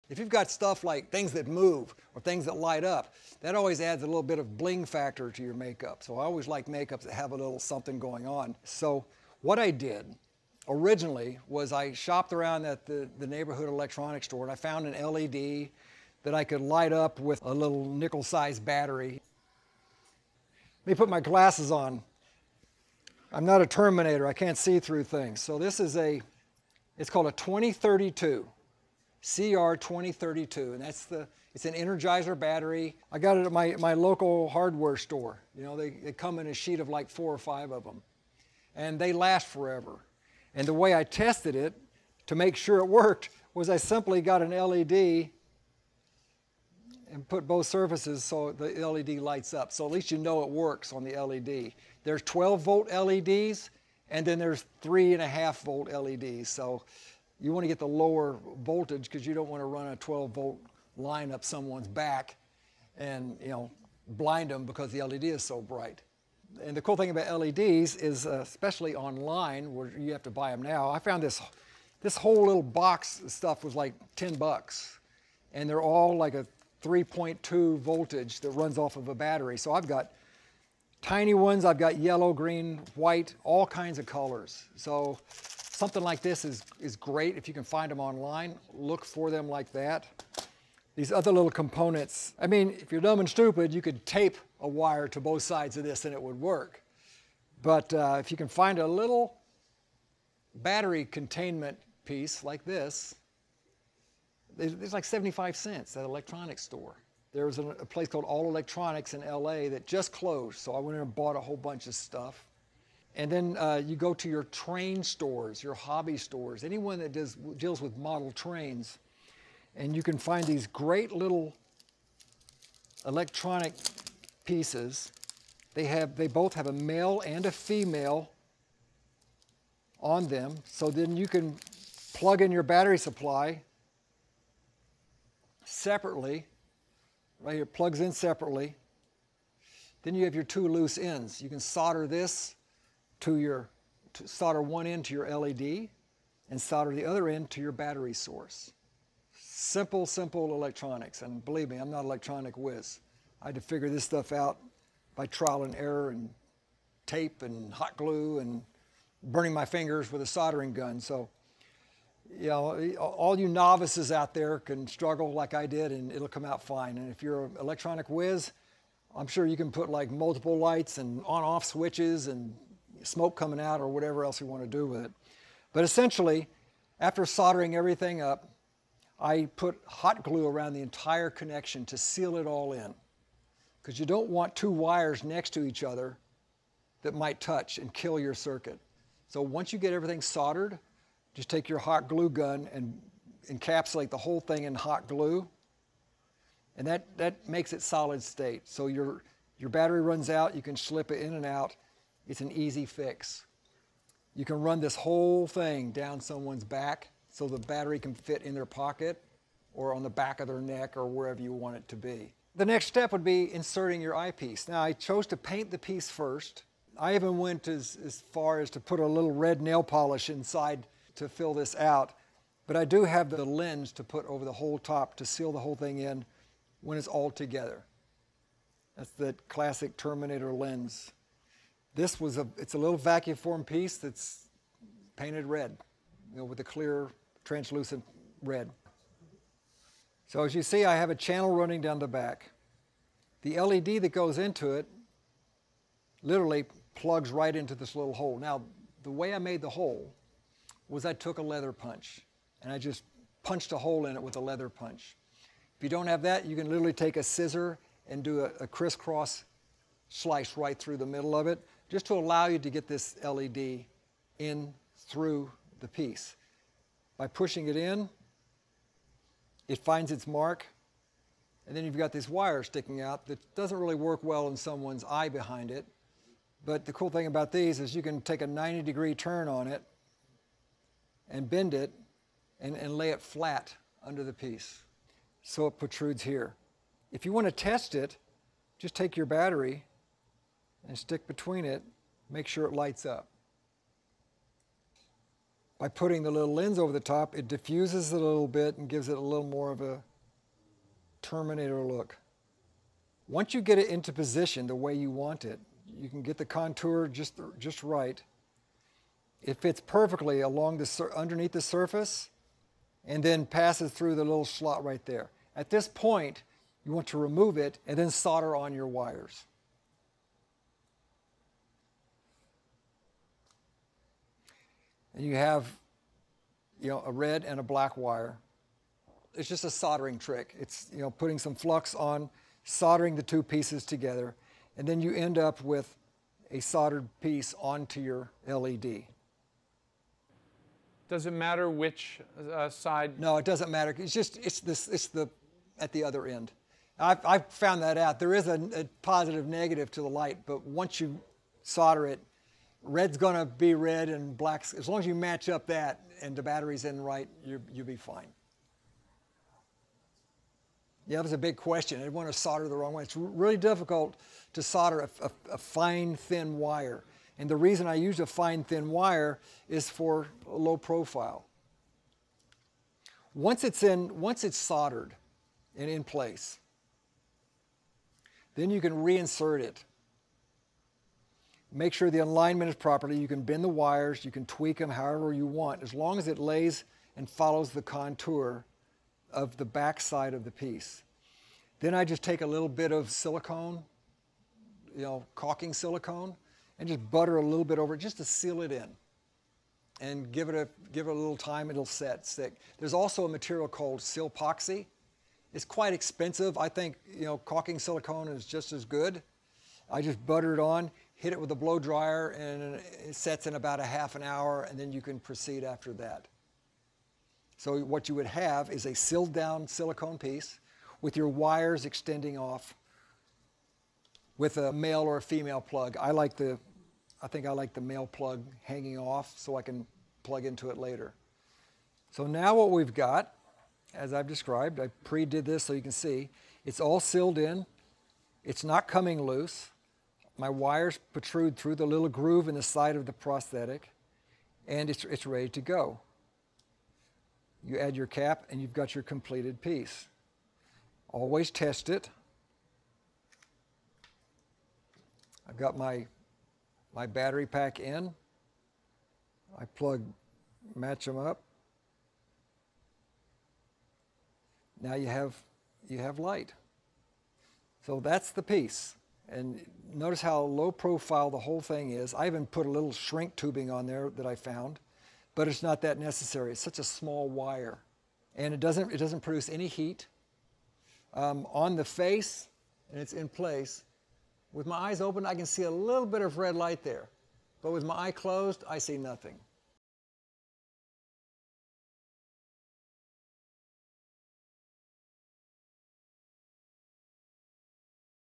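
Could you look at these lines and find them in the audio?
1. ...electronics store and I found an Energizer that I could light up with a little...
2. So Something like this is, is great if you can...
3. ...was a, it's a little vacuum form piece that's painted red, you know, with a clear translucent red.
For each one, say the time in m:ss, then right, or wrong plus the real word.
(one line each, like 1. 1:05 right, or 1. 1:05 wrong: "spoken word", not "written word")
1. 0:13 wrong: "LED", not "Energizer"
2. 1:24 right
3. 3:52 right.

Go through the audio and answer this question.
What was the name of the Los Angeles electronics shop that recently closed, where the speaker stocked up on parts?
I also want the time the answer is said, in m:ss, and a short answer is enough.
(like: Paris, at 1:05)
All Electronics, at 1:48.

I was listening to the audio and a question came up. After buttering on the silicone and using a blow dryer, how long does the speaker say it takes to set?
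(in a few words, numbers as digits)
half an hour.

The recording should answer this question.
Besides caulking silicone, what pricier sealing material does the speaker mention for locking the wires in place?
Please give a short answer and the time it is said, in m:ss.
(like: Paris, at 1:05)
silpoxy, at 6:43.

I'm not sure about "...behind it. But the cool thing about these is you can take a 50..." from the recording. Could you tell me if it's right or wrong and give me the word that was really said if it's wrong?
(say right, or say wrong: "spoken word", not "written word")
wrong: "90", not "50".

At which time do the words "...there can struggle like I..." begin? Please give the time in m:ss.
2:44.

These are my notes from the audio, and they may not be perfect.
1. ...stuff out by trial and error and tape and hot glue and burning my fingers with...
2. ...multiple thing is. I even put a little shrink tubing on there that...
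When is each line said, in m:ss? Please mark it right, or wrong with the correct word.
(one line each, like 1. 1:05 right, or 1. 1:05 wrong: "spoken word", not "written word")
1. 2:34 right
2. 7:51 wrong: "whole", not "multiple".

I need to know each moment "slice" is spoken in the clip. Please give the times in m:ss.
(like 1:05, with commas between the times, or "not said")
4:20.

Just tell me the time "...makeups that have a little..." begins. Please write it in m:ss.
0:06.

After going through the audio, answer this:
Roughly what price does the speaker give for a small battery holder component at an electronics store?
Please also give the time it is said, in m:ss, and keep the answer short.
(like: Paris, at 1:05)
75 cents, at 1:45.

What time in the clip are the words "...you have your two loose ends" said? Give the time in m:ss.
2:20.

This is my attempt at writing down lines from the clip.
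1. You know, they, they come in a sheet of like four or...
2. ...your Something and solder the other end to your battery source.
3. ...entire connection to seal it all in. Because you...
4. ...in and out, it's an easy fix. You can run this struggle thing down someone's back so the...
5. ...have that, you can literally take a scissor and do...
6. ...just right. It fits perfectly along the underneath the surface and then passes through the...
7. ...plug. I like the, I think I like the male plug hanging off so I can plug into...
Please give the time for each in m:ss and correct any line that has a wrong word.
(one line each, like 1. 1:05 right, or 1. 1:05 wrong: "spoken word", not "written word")
1. 0:35 right
2. 2:25 wrong: "LED", not "Something"
3. 3:00 right
4. 3:21 wrong: "whole", not "struggle"
5. 4:16 right
6. 5:07 right
7. 7:05 right.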